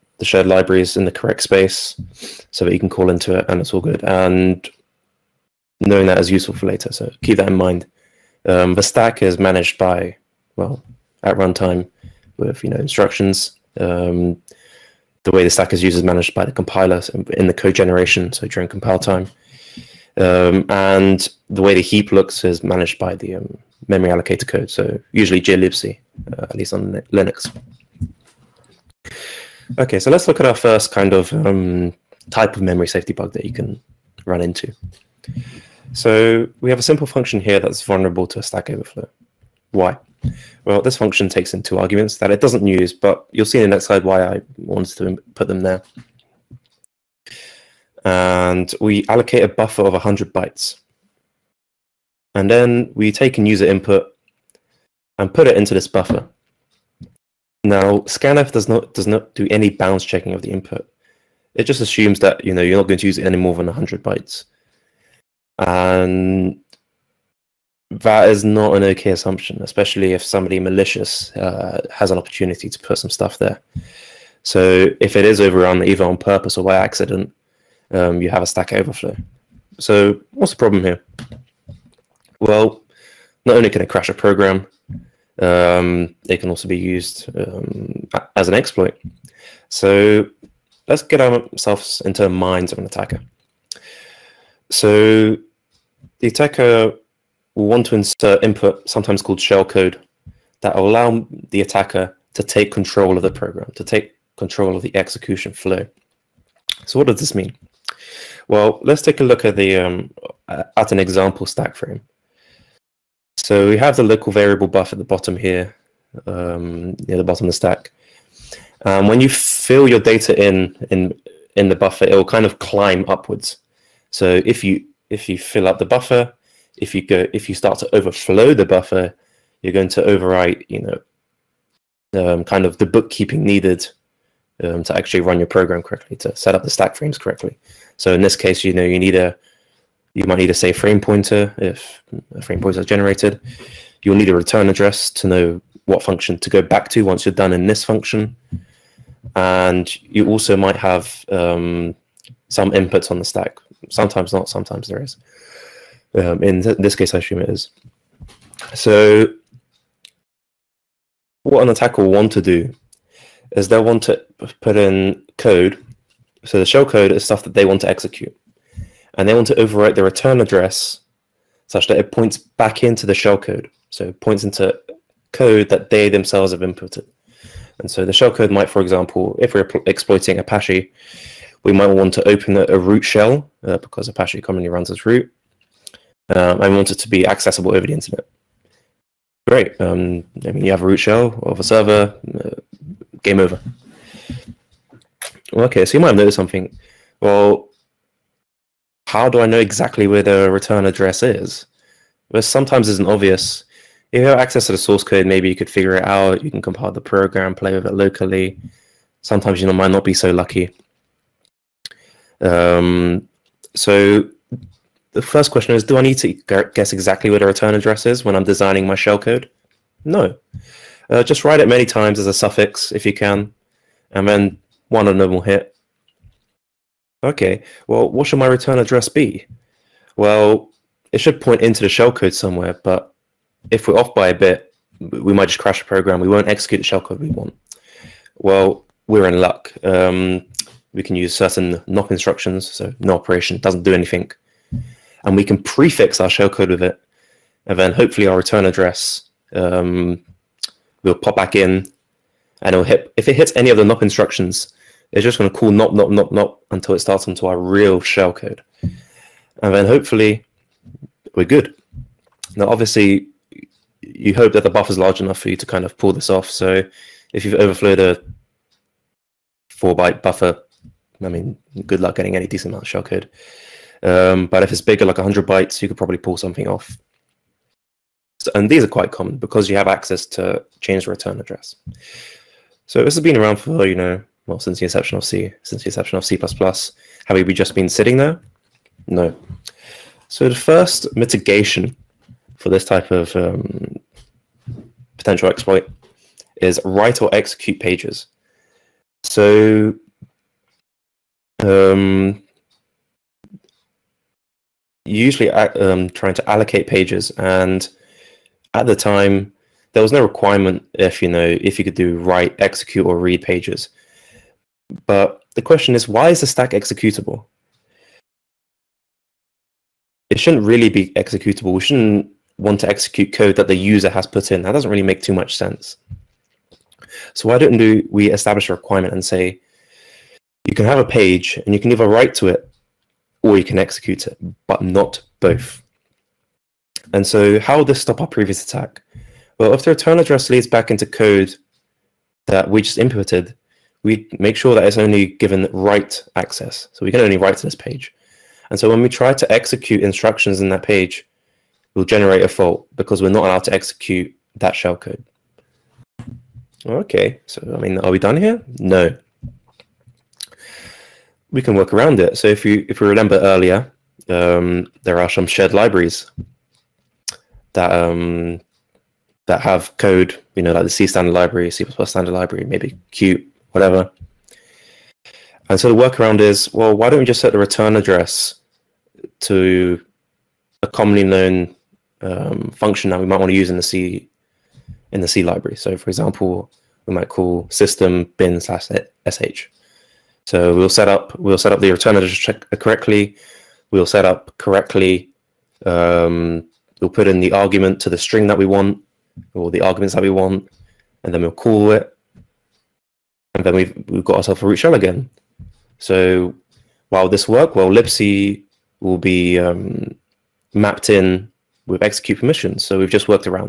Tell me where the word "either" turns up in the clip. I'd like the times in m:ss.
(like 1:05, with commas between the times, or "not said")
1:15, 5:31.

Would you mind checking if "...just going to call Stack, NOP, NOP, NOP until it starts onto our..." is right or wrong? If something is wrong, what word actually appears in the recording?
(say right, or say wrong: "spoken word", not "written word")
wrong: "NOP", not "Stack".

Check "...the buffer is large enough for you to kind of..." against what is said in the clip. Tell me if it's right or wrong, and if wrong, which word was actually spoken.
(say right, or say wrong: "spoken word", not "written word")
right.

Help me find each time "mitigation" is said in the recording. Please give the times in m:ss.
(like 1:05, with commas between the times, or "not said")
4:51.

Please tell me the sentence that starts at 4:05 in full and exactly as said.
And we can prefix our shellcode with it.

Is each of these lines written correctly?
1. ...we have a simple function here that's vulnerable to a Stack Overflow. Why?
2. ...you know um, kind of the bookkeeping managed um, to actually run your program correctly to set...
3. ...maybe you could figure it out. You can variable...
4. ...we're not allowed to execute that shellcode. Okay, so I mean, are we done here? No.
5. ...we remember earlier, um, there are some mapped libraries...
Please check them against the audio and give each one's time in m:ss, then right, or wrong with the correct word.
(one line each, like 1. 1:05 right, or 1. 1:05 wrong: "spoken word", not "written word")
1. 0:36 right
2. 2:10 wrong: "needed", not "managed"
3. 3:25 wrong: "compile", not "variable"
4. 5:53 right
5. 6:03 wrong: "shared", not "mapped".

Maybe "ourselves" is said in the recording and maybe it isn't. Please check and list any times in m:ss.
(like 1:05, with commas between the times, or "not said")
1:31, 6:44.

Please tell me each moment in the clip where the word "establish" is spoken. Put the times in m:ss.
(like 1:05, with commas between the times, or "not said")
5:28.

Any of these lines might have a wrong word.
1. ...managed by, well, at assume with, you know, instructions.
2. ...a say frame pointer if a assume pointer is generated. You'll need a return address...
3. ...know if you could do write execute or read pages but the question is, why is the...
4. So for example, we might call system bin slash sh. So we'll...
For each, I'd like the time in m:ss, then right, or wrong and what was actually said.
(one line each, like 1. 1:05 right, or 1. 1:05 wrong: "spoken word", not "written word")
1. 0:09 wrong: "runtime", not "assume"
2. 2:20 wrong: "frame", not "assume"
3. 5:11 right
4. 6:25 right.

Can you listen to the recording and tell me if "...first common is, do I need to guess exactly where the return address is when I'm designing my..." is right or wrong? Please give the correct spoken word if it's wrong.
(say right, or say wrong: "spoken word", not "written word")
wrong: "question", not "common".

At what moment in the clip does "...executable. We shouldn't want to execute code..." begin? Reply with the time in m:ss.
5:21.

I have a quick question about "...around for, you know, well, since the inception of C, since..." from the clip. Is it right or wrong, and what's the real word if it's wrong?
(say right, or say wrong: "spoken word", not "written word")
right.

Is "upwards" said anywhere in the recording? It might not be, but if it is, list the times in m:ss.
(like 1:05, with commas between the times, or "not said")
2:03.